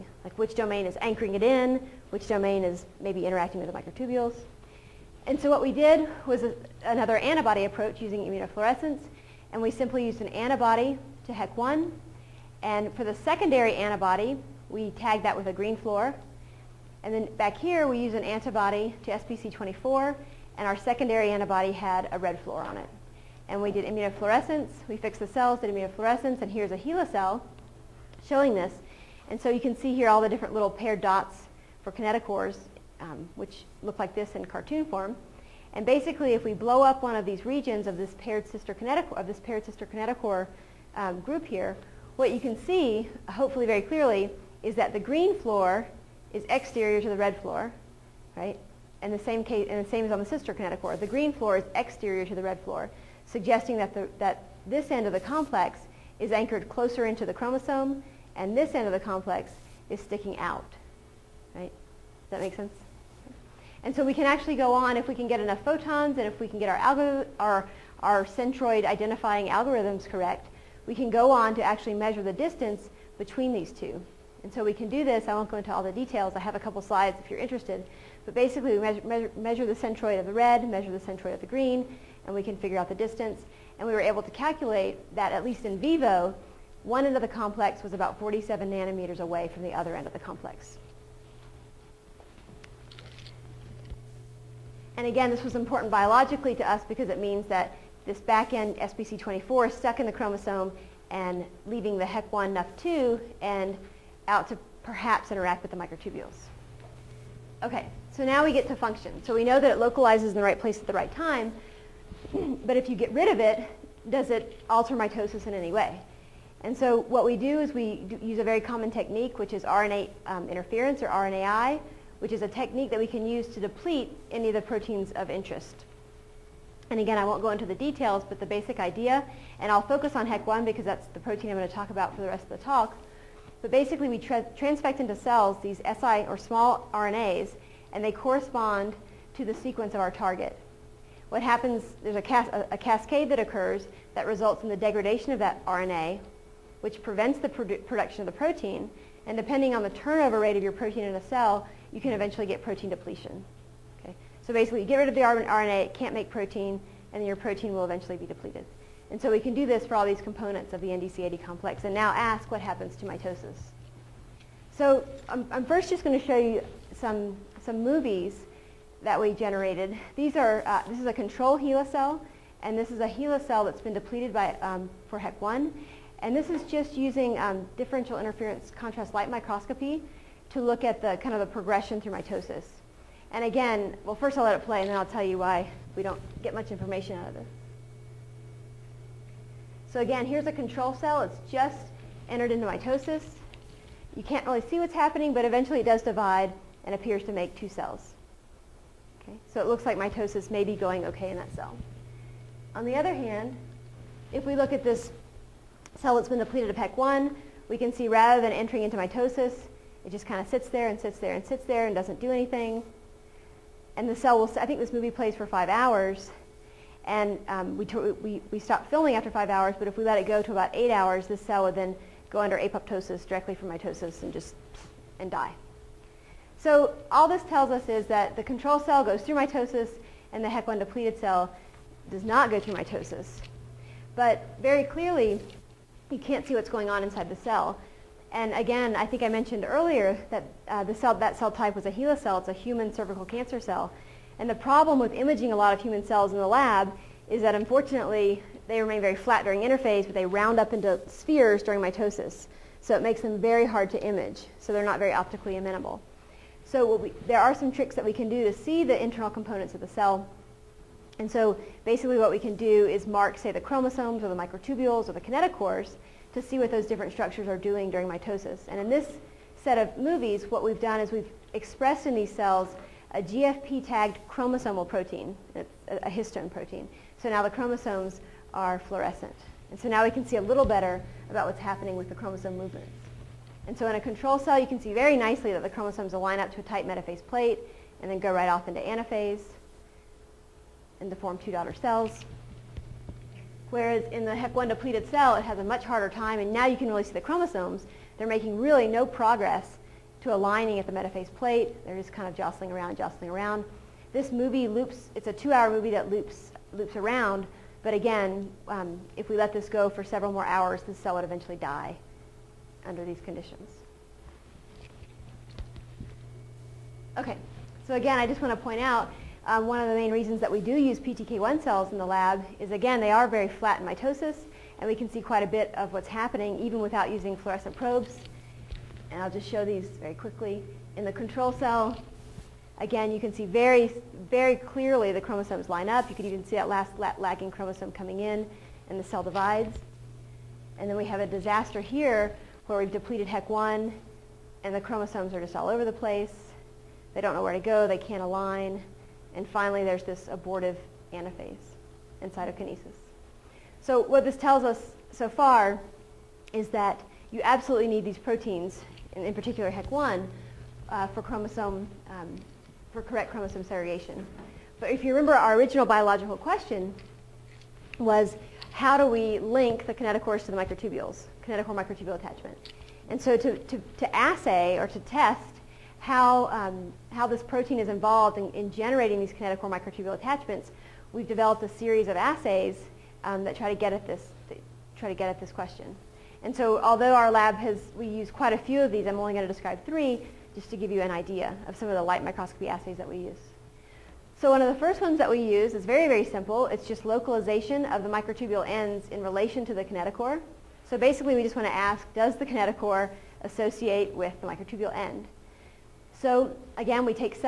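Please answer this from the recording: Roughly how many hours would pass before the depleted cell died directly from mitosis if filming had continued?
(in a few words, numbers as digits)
8 hours.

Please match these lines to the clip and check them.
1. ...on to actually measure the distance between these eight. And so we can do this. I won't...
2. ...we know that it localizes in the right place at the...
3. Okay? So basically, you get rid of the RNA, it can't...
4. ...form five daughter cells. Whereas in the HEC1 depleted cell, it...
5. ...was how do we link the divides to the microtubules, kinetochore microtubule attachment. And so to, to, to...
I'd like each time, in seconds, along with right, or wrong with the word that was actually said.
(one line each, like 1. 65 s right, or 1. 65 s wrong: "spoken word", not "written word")
1. 71 s wrong: "two", not "eight"
2. 109 s right
3. 154 s right
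4. 291 s wrong: "two", not "five"
5. 367 s wrong: "kinetochores", not "divides".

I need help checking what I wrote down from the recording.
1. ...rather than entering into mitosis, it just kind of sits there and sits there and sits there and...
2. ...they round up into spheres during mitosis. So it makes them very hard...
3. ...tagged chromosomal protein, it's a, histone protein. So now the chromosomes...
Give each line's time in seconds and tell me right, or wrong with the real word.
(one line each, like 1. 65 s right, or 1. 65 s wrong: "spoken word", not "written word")
1. 208 s right
2. 250 s right
3. 273 s right.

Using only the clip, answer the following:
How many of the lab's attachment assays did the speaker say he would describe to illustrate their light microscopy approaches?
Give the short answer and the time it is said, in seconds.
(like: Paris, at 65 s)
3, at 389 s.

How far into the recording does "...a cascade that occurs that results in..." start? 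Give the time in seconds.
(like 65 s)
142 s.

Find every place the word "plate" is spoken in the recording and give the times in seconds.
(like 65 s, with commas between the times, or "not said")
287 s, 301 s.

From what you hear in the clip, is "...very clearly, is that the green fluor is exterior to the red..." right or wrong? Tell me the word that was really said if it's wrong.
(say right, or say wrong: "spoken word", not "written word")
right.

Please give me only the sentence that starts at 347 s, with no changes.
They don't know where to go.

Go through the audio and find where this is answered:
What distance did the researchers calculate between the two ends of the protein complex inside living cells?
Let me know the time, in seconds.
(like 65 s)
88 s.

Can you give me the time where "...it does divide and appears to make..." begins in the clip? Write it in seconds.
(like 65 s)
195 s.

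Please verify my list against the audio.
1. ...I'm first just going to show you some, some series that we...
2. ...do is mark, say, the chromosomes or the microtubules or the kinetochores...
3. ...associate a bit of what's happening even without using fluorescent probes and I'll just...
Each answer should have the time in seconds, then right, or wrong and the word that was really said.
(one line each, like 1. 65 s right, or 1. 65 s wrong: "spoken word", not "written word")
1. 165 s wrong: "movies", not "series"
2. 262 s right
3. 325 s wrong: "quite", not "associate".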